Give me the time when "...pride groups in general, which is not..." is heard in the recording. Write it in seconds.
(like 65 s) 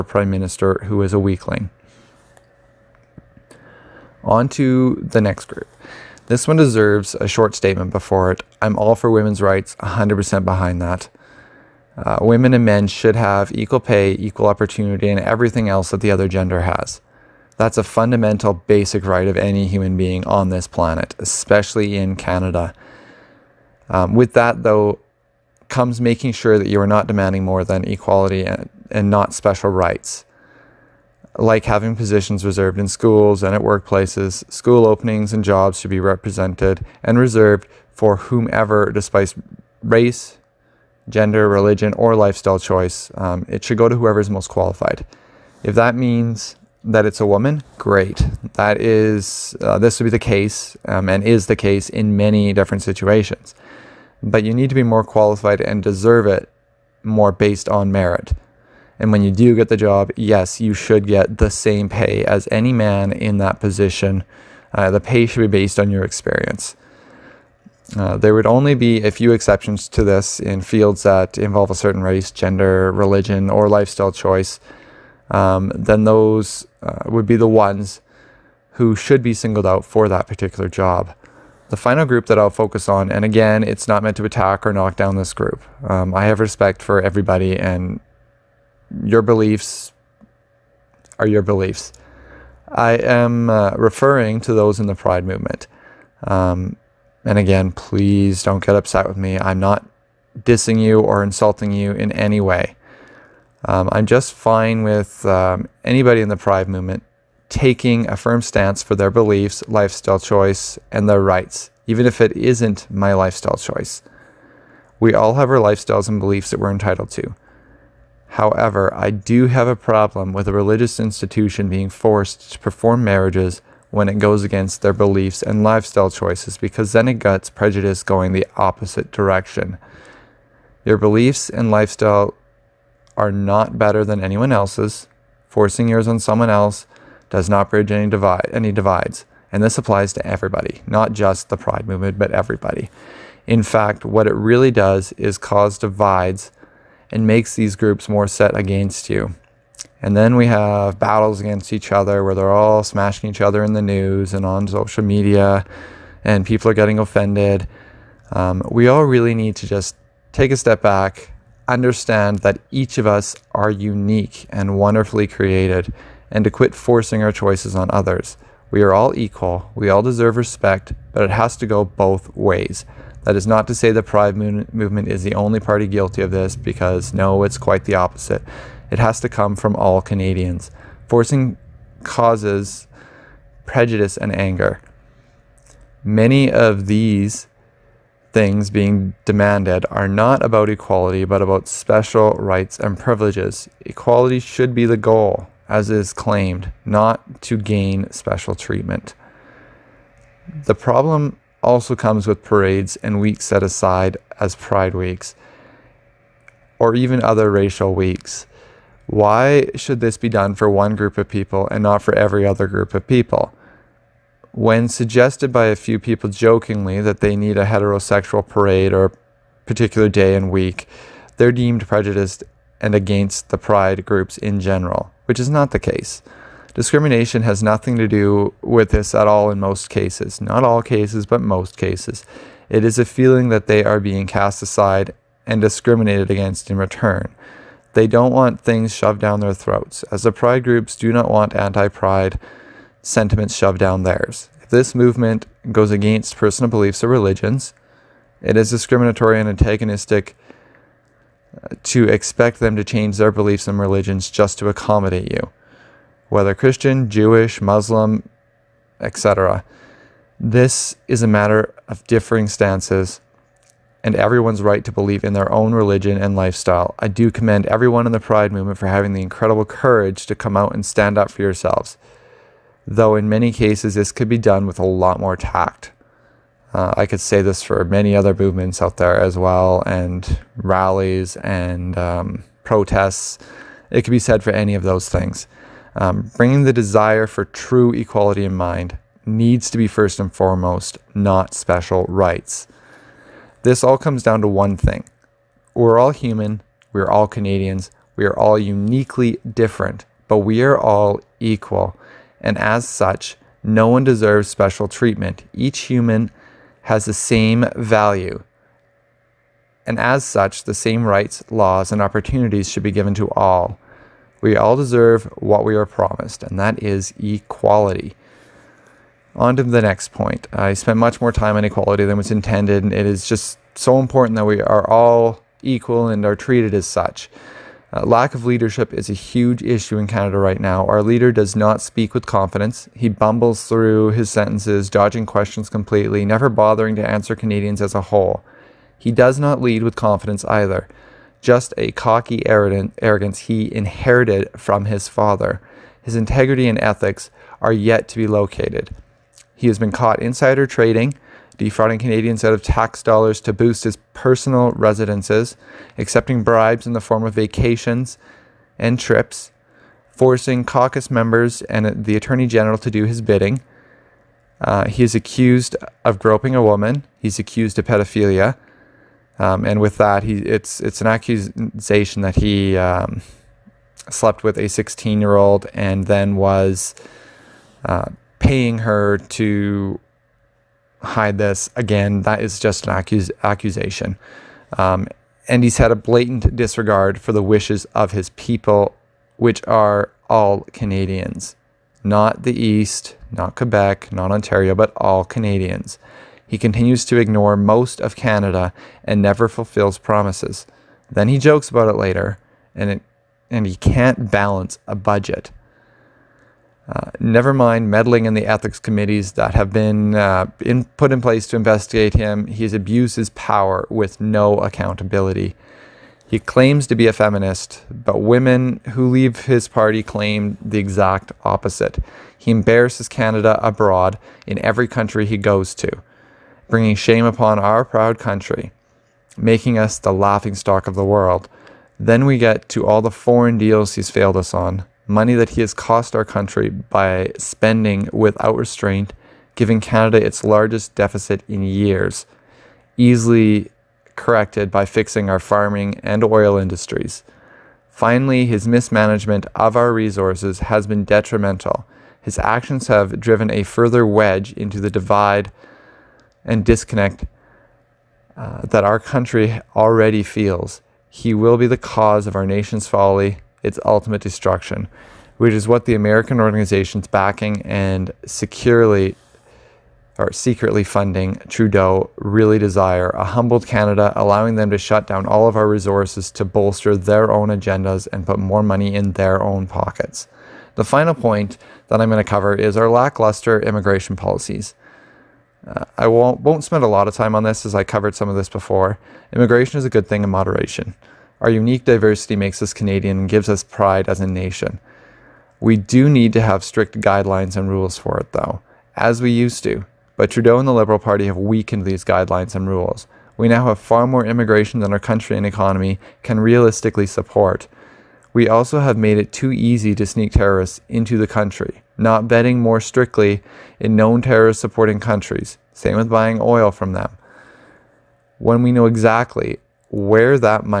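223 s.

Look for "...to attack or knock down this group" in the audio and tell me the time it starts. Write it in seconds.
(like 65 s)
84 s.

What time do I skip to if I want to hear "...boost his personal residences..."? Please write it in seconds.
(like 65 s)
353 s.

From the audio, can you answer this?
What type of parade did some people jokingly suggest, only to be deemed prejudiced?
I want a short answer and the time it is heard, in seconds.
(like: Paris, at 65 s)
Heterosexual parade, at 217 s.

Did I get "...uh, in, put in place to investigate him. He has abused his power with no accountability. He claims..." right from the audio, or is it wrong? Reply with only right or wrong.
right.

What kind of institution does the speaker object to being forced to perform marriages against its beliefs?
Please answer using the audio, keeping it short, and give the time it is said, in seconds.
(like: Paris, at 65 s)
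Religious institution, at 120 s.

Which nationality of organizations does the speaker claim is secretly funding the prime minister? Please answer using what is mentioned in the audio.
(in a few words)
American.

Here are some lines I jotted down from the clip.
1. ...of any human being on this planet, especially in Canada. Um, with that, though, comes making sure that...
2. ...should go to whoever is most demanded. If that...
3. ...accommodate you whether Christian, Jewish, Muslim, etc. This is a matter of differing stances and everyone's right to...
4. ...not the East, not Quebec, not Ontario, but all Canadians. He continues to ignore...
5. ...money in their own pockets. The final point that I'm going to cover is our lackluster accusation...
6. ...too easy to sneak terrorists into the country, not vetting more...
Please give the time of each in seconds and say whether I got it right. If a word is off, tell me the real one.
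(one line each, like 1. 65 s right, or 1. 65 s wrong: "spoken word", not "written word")
1. 19 s right
2. 43 s wrong: "qualified", not "demanded"
3. 254 s right
4. 392 s right
5. 478 s wrong: "immigration", not "accusation"
6. 509 s right.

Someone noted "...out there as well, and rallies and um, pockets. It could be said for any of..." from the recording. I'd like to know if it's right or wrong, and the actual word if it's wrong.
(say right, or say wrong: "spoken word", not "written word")
wrong: "protests", not "pockets".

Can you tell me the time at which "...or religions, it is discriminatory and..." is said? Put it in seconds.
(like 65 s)
247 s.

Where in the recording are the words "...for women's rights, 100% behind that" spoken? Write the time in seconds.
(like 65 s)
8 s.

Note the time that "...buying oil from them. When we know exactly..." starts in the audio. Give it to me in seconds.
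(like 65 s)
516 s.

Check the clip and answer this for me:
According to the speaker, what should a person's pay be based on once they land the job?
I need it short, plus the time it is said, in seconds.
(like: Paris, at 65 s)
Experience, at 66 s.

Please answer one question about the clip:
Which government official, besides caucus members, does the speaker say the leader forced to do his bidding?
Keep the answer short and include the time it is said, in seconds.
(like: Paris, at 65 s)
Attorney General, at 362 s.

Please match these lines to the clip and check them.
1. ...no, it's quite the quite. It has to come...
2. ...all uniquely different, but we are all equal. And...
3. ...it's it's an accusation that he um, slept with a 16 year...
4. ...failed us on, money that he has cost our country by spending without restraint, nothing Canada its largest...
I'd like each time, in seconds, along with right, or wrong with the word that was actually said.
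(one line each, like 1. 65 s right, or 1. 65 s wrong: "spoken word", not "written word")
1. 177 s wrong: "opposite", not "quite"
2. 298 s right
3. 370 s right
4. 434 s wrong: "giving", not "nothing".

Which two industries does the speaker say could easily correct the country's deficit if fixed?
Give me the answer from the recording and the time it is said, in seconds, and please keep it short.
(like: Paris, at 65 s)
Farming and oil, at 445 s.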